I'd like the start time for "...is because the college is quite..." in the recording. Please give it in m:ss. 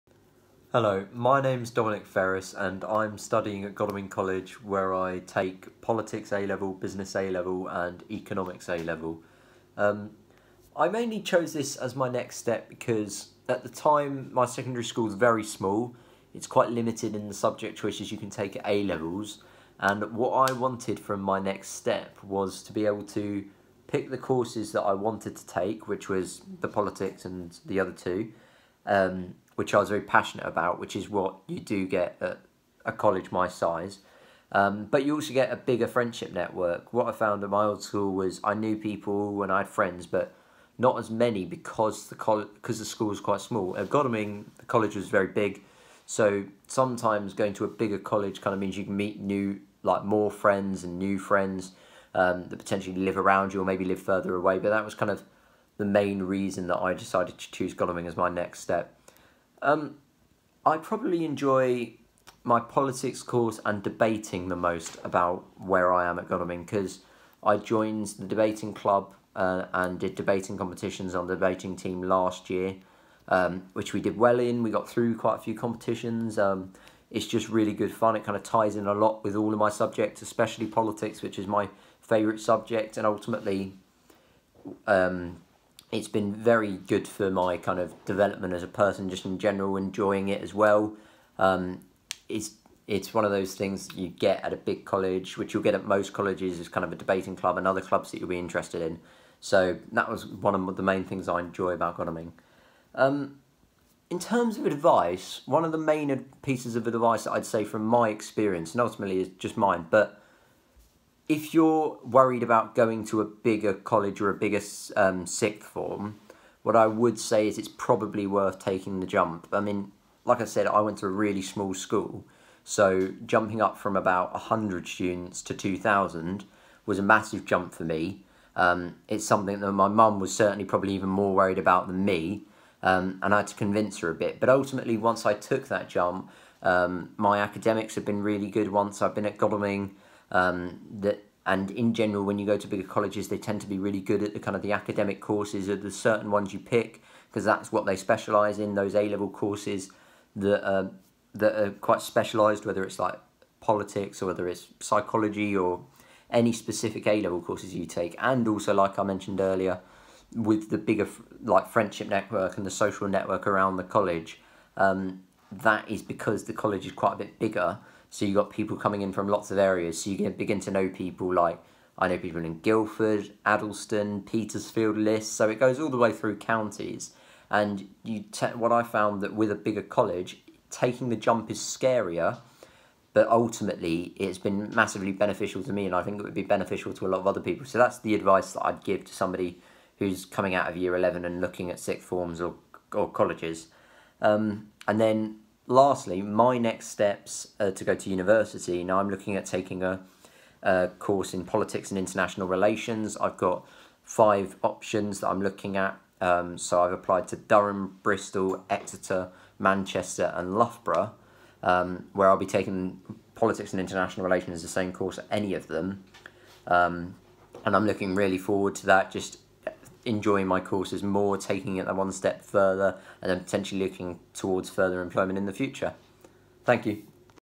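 2:45.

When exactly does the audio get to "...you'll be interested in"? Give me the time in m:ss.
1:38.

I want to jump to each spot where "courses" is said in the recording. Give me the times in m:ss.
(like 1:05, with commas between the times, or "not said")
0:24, 1:03, 2:25, 2:29, 2:37, 3:20, 3:34, 3:40.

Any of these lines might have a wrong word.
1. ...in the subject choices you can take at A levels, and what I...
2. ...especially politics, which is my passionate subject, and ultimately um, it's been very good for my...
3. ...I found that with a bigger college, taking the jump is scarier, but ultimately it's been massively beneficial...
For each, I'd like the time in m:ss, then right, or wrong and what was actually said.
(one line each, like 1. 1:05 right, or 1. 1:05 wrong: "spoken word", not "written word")
1. 0:17 right
2. 1:20 wrong: "favourite", not "passionate"
3. 2:58 right.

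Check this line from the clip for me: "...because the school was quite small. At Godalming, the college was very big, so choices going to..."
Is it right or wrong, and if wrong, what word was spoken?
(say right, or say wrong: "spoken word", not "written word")
wrong: "sometimes", not "choices".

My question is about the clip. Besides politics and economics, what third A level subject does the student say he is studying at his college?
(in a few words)
Business.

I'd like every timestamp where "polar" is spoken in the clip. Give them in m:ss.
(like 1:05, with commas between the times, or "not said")
not said.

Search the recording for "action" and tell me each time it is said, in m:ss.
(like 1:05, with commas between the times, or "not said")
not said.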